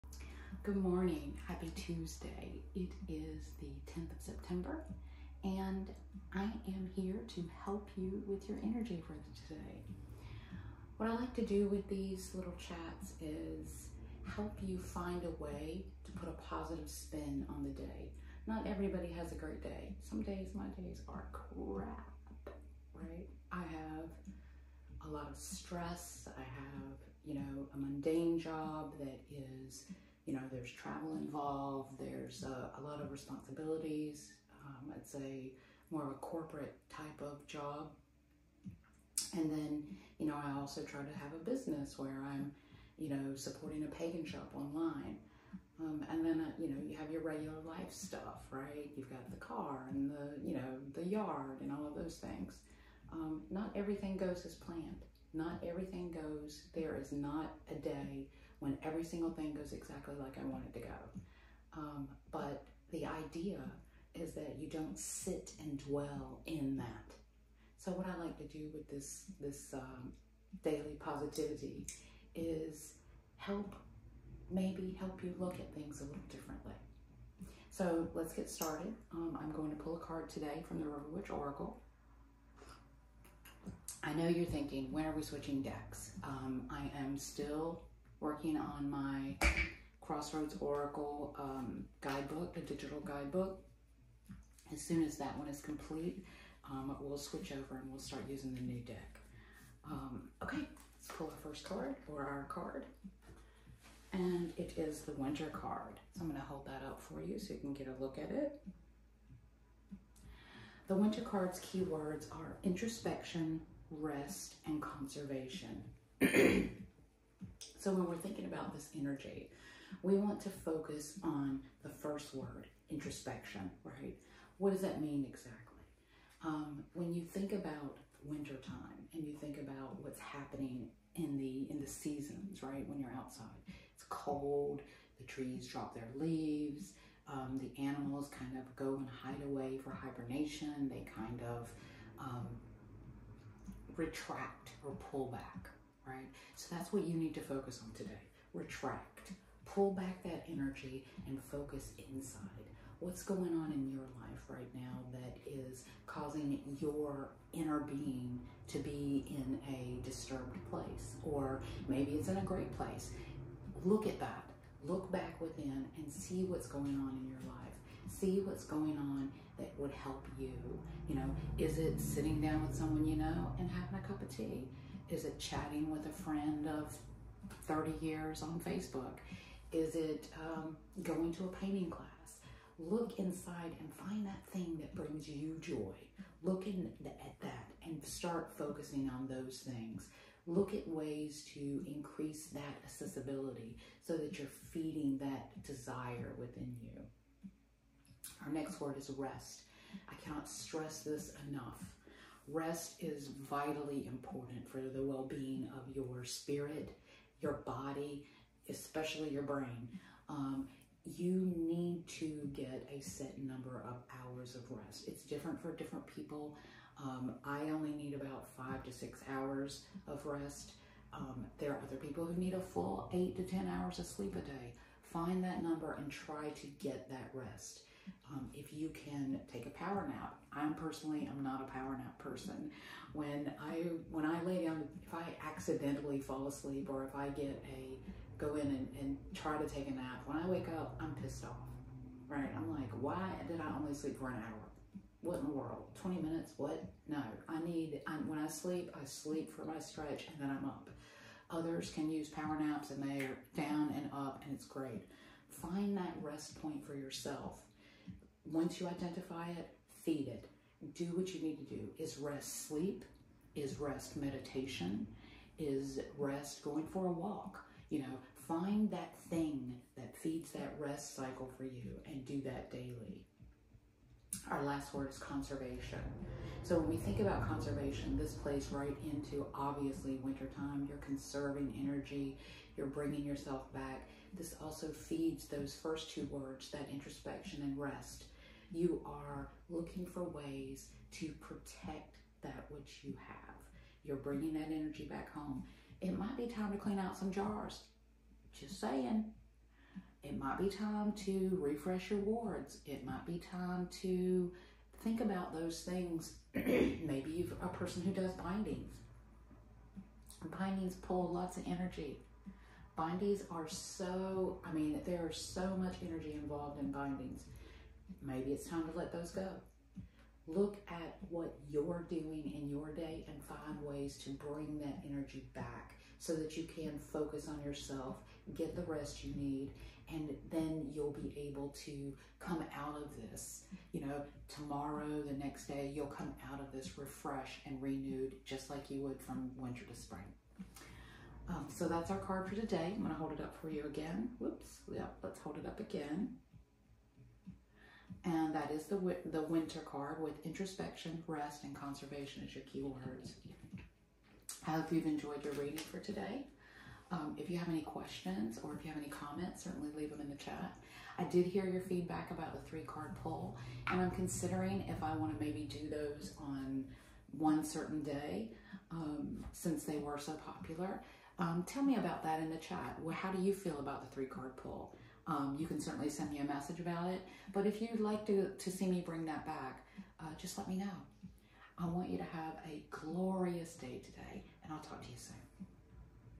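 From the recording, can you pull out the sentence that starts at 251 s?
Others can use power naps and they're down and up and it's great.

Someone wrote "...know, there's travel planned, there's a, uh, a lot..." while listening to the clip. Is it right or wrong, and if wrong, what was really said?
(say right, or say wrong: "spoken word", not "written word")
wrong: "involved", not "planned".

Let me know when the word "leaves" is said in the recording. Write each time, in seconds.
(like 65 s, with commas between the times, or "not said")
136 s, 359 s.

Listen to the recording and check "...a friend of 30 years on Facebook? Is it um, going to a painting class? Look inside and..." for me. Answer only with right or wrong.
right.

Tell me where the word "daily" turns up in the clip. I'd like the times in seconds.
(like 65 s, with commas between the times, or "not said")
70 s, 272 s.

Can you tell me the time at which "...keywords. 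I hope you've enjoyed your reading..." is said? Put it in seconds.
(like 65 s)
352 s.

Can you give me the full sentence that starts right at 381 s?
I want you to have a glorious day today, and I'll talk to you soon.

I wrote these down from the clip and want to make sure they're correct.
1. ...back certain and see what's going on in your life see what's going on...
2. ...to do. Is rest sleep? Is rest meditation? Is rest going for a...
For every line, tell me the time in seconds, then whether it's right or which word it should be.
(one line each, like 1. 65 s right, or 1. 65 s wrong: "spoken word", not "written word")
1. 165 s wrong: "within", not "certain"
2. 261 s right.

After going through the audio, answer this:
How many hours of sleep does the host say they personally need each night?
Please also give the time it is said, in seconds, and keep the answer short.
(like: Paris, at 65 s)
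5 to 6, at 218 s.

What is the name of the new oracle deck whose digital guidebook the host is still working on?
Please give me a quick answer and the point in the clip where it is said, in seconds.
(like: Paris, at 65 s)
Crossroads Oracle, at 89 s.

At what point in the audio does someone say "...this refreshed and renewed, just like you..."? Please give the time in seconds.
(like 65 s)
336 s.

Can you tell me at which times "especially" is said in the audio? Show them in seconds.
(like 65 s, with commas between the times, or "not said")
208 s.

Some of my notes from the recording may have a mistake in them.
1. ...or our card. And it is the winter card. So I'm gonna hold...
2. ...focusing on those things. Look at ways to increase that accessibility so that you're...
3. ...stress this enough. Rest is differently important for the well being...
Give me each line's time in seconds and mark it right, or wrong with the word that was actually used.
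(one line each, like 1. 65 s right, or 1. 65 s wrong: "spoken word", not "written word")
1. 102 s right
2. 188 s right
3. 200 s wrong: "vitally", not "differently".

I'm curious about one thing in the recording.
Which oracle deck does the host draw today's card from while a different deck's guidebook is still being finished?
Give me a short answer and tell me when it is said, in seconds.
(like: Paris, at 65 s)
River Witch Oracle, at 80 s.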